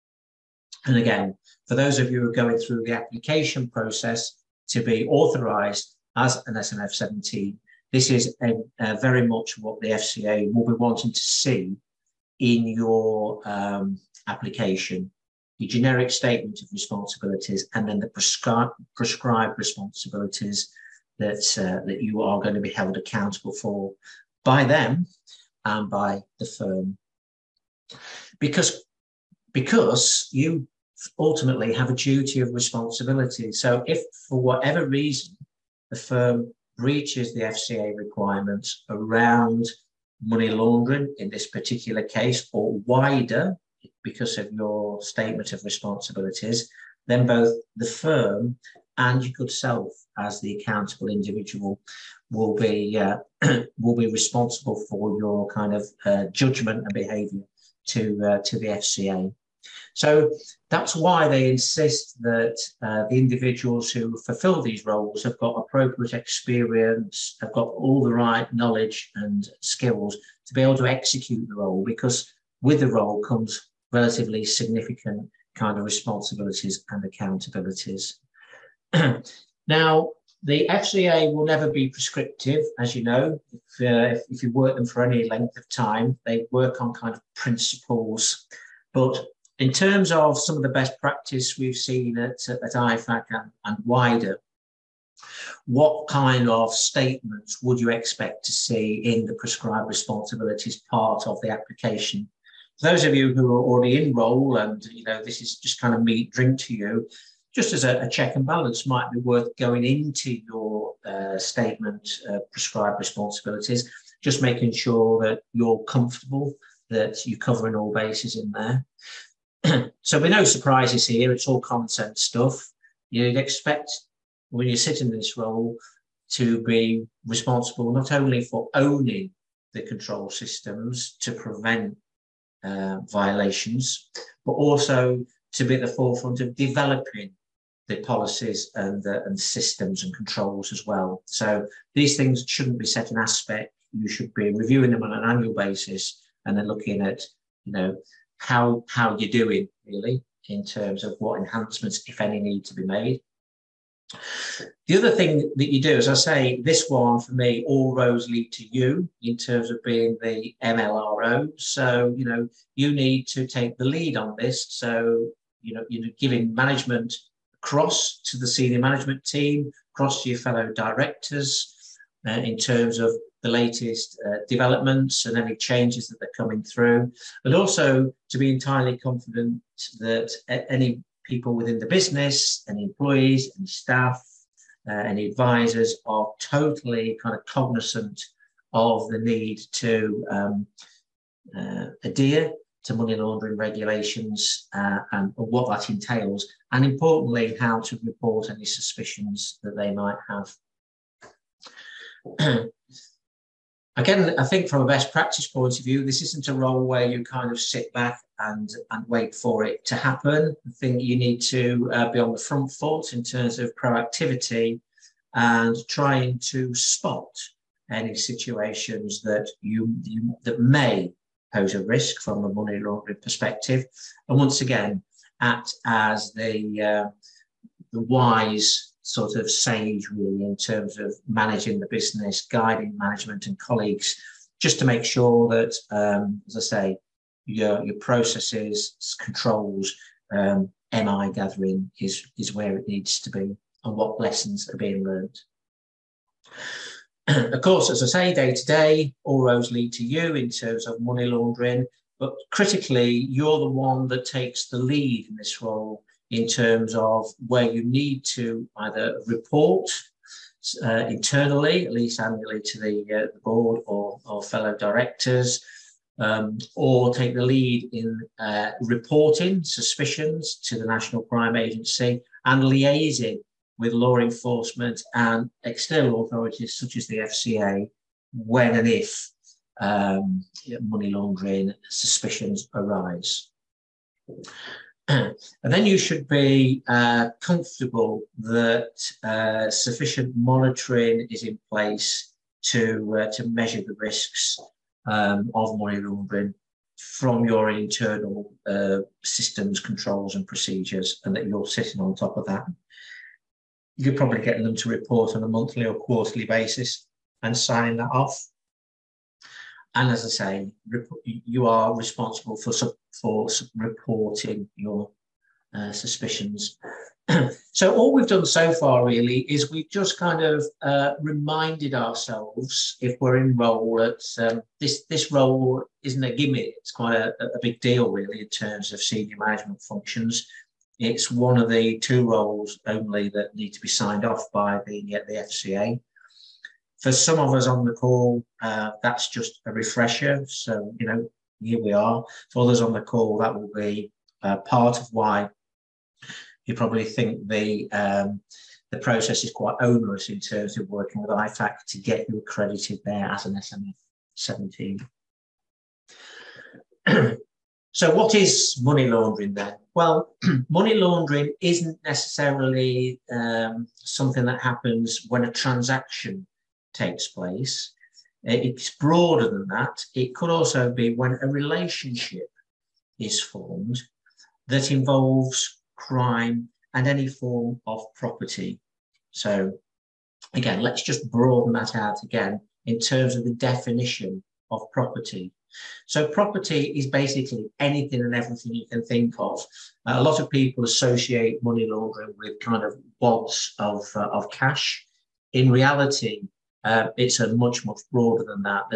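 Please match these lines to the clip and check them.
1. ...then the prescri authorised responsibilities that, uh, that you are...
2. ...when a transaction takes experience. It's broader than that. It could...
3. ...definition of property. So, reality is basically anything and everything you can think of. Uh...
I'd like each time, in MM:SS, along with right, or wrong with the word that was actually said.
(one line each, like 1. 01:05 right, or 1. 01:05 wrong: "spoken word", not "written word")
1. 00:17 wrong: "prescribed", not "authorised"
2. 06:05 wrong: "place", not "experience"
3. 06:23 wrong: "property", not "reality".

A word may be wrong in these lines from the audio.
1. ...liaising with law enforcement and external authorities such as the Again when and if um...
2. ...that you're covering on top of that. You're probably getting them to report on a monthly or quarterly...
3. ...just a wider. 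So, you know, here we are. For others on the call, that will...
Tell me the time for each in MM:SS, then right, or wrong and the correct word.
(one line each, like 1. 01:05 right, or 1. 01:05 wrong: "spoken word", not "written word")
1. 04:32 wrong: "FCA", not "Again"
2. 05:01 wrong: "sitting", not "covering"
3. 05:39 wrong: "refresher", not "wider".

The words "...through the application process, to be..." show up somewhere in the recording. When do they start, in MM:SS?
00:02.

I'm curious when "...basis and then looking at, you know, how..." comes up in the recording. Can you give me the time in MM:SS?
02:25.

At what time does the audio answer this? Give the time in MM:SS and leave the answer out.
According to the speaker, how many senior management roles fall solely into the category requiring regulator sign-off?
05:31.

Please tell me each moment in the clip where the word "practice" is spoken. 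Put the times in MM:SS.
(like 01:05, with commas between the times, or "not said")
01:30, 03:25.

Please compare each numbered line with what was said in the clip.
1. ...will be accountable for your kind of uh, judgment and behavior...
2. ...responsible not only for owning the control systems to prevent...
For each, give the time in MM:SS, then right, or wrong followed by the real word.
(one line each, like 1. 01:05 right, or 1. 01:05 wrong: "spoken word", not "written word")
1. 00:53 wrong: "responsible", not "accountable"
2. 02:07 right.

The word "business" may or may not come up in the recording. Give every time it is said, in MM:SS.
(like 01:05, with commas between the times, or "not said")
03:01, 03:51.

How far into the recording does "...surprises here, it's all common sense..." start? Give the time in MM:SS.
02:00.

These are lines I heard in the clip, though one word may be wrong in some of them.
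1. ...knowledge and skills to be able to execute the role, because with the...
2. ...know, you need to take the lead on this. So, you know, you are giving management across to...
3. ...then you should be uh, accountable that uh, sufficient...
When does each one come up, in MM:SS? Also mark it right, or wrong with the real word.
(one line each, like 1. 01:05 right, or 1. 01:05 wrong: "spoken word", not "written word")
1. 01:08 right
2. 02:42 right
3. 04:45 wrong: "comfortable", not "accountable".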